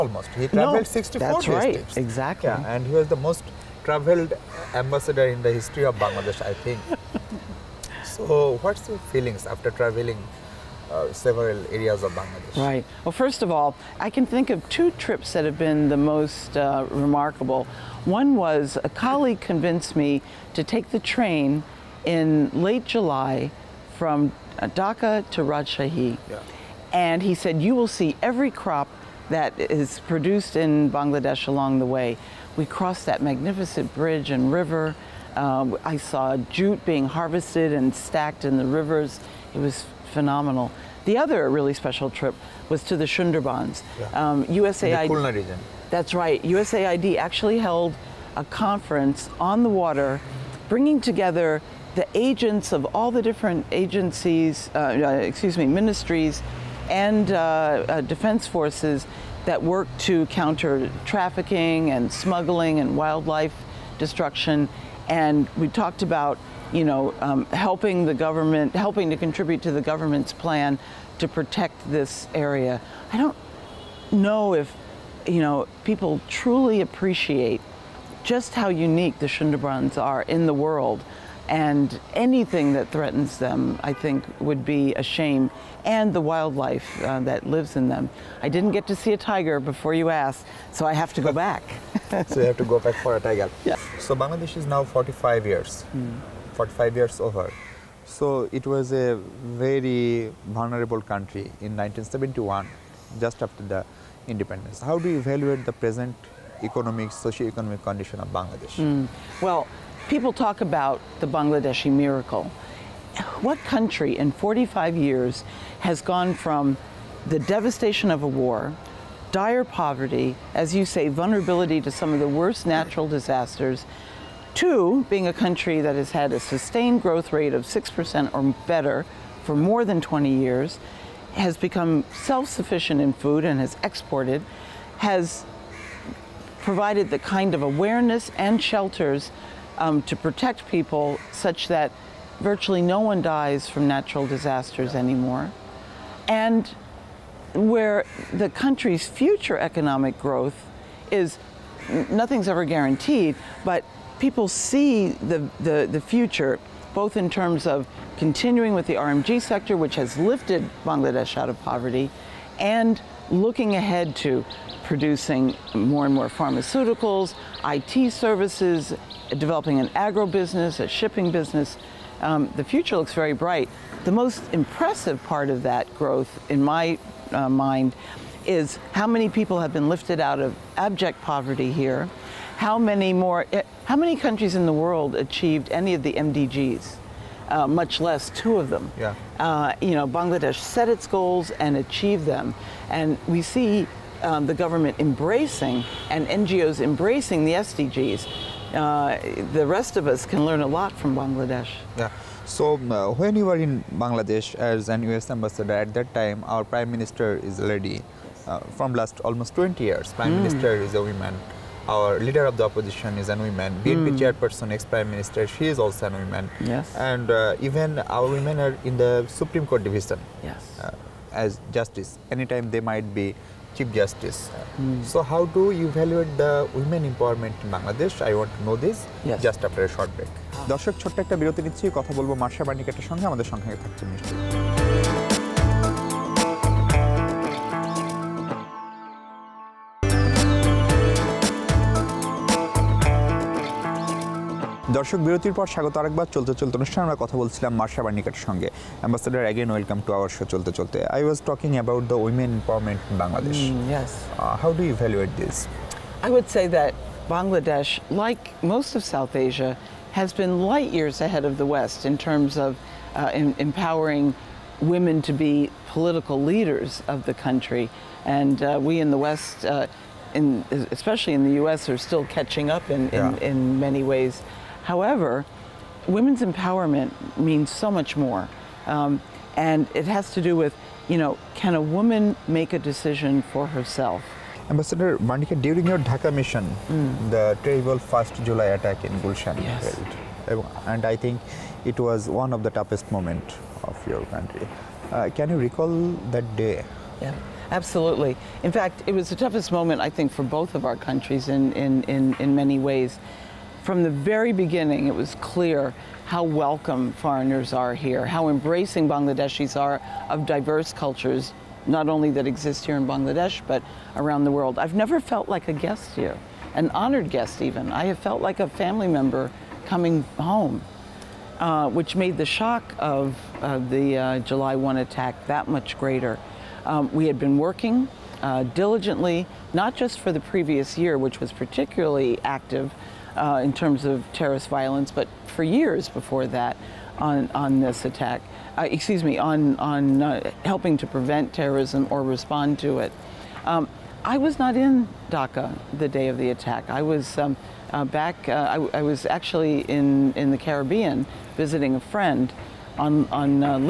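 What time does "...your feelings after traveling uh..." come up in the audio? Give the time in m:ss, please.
0:08.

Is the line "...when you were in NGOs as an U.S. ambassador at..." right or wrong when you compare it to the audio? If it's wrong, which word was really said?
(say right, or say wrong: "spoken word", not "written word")
wrong: "Bangladesh", not "NGOs".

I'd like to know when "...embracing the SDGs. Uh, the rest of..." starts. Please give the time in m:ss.
3:16.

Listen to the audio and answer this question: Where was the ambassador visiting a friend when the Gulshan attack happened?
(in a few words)
The Caribbean.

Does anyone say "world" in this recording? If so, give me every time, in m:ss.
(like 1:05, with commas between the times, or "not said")
1:20, 3:04, 5:14.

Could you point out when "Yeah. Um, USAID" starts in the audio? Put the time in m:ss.
0:43.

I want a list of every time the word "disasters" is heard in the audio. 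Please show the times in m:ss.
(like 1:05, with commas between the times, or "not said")
2:03, 2:24.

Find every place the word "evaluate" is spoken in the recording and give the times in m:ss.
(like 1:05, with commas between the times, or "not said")
1:45, 3:45.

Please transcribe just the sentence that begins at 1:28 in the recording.
I didn't get to see a tiger before you asked, so I have to go back.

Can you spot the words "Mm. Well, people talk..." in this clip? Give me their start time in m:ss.
1:48.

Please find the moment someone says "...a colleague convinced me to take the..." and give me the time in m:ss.
0:18.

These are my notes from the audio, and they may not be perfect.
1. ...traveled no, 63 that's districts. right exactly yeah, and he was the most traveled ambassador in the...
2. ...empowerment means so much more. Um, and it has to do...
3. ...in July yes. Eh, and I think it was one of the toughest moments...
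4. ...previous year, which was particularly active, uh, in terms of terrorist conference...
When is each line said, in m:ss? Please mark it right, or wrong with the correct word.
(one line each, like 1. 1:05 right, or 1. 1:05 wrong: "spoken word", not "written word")
1. 0:00 wrong: "64", not "63"
2. 4:36 right
3. 4:49 wrong: "Gulshan", not "July"
4. 5:30 wrong: "violence", not "conference".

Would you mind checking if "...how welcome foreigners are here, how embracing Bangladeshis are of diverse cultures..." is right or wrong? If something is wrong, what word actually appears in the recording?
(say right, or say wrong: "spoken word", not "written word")
right.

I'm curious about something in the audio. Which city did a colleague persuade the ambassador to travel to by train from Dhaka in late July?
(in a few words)
Rajshahi.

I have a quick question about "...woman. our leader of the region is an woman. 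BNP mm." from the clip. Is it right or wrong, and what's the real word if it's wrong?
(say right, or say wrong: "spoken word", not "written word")
wrong: "opposition", not "region".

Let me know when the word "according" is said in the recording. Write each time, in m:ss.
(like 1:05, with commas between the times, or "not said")
not said.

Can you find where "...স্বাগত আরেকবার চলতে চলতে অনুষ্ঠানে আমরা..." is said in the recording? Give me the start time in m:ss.
4:05.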